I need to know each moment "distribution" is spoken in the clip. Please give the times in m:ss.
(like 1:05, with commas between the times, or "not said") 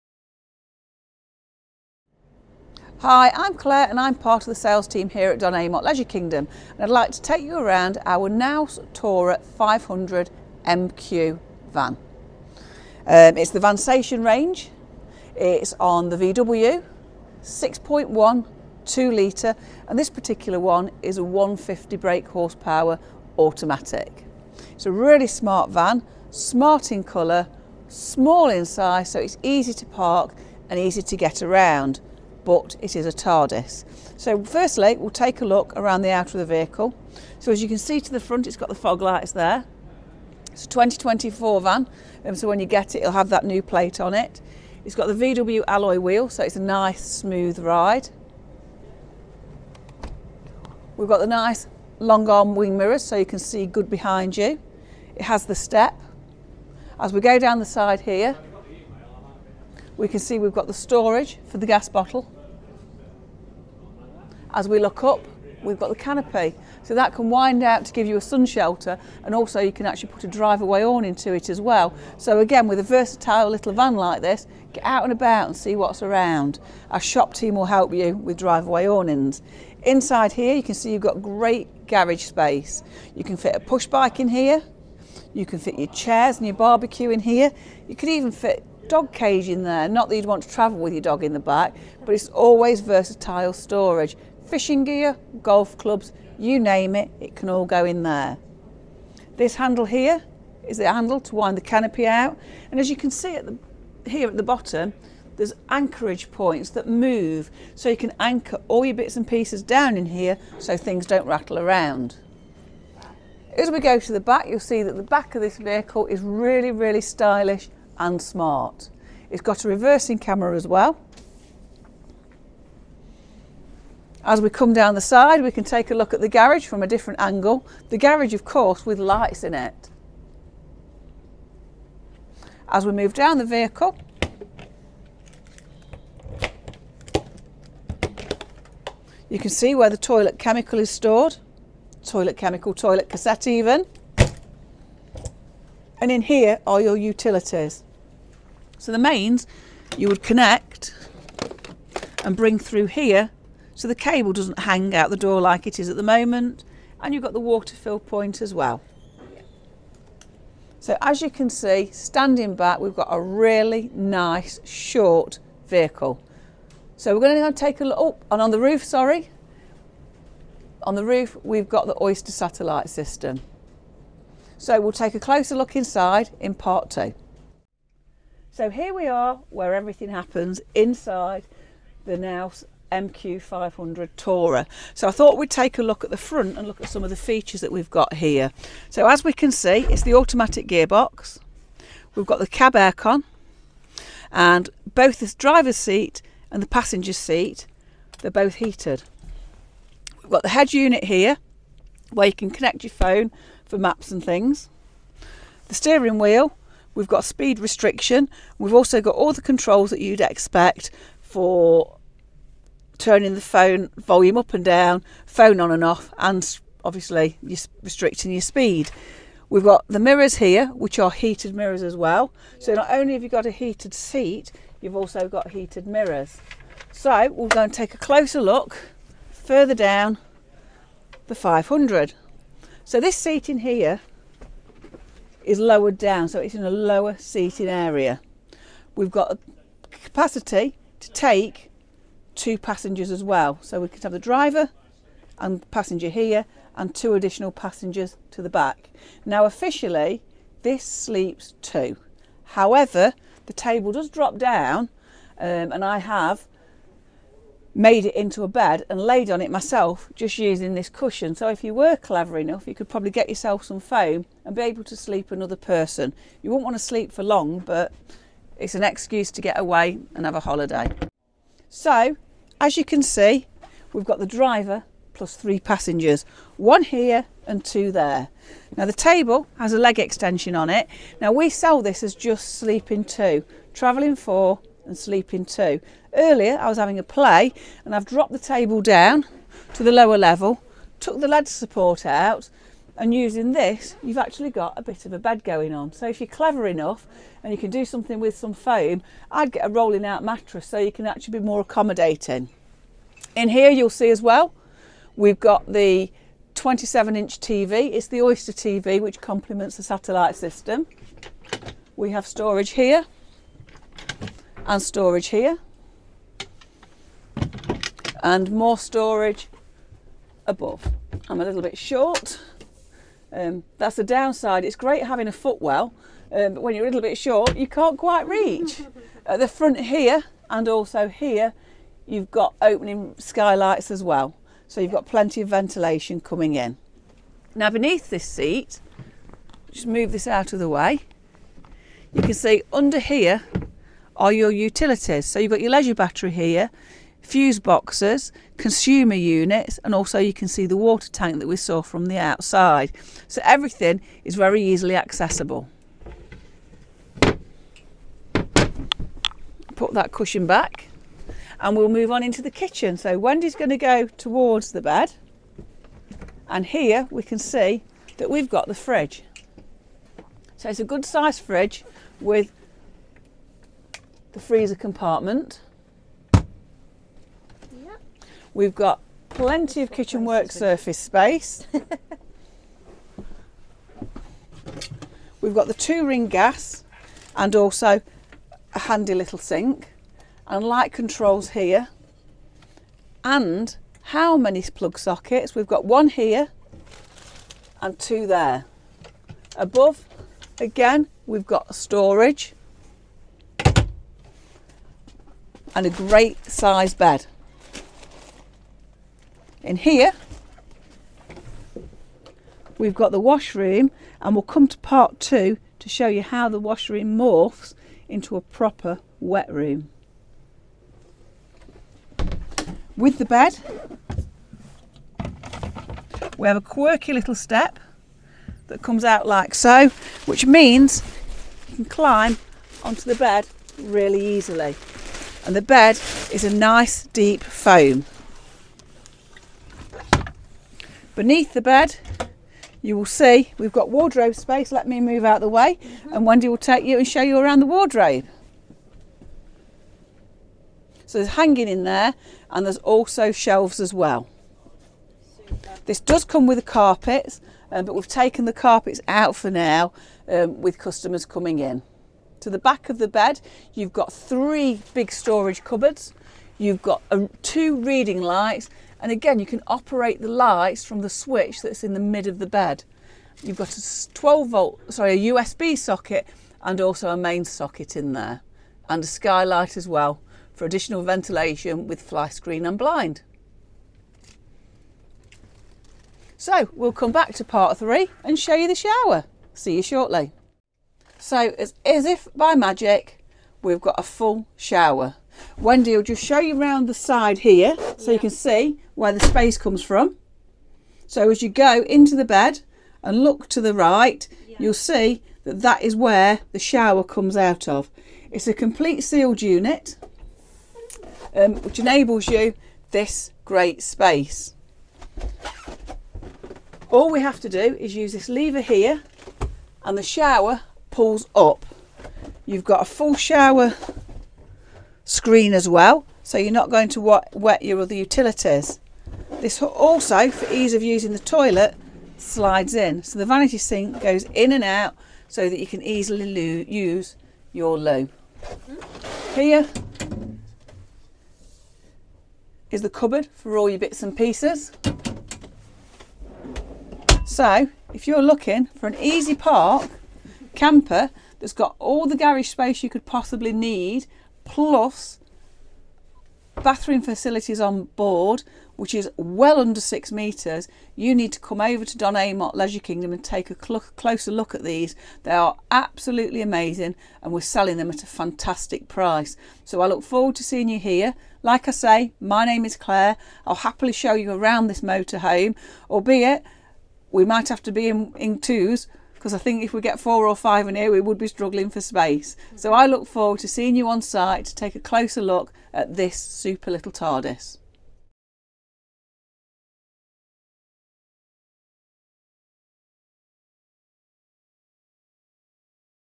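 not said.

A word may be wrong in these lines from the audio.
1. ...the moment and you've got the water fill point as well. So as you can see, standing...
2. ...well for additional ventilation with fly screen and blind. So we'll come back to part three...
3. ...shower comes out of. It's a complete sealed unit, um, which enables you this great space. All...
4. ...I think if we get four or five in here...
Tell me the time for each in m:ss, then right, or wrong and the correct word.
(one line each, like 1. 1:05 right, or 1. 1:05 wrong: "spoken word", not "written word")
1. 2:35 right
2. 7:59 right
3. 8:26 right
4. 9:39 right.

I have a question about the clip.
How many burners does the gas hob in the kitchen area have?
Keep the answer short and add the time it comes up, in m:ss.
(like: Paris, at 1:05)
2, at 6:25.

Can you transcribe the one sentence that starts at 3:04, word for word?
So I thought we'd take a look at the front and look at some of the features that we've got here.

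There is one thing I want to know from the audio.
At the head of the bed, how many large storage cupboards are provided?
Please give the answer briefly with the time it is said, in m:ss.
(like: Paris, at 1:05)
3, at 7:44.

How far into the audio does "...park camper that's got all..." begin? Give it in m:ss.
9:09.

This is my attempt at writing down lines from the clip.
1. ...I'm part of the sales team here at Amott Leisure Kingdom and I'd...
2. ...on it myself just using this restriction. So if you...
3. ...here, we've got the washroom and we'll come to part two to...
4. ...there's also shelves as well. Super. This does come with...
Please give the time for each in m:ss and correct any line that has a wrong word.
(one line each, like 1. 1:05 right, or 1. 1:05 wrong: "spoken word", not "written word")
1. 0:03 wrong: "Don", not "Amott"
2. 4:19 wrong: "cushion", not "restriction"
3. 6:49 right
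4. 7:32 right.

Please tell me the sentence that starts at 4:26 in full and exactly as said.
You wouldn't want to sleep for long, but it's an excuse to get away and have a holiday.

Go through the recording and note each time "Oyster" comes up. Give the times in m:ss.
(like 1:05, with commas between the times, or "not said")
2:52, 5:08.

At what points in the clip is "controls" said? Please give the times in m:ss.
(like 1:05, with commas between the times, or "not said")
3:29, 6:30.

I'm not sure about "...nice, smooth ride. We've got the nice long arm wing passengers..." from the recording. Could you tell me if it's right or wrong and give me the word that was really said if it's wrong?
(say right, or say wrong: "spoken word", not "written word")
wrong: "mirrors", not "passengers".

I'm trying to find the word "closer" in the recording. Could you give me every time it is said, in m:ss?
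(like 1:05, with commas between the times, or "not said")
2:55, 3:47, 9:23, 9:44.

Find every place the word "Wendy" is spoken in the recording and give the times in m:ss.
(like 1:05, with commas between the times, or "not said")
6:03, 7:26, 8:15.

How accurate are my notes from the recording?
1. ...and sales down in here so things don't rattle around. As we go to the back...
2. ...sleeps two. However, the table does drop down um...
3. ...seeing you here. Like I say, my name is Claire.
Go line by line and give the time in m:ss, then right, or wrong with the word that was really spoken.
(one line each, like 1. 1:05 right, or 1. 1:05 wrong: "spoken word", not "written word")
1. 1:49 wrong: "pieces", not "sales"
2. 4:10 right
3. 9:30 right.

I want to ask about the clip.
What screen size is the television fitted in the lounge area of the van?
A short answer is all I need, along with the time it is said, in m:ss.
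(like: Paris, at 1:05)
27 inch, at 5:06.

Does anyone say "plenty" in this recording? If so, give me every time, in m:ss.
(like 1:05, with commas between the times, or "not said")
5:35, 6:19.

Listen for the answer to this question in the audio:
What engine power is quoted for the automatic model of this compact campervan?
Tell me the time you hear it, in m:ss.
0:21.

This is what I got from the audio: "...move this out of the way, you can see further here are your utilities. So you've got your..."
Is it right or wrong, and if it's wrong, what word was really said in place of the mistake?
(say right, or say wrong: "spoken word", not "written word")
wrong: "under", not "further".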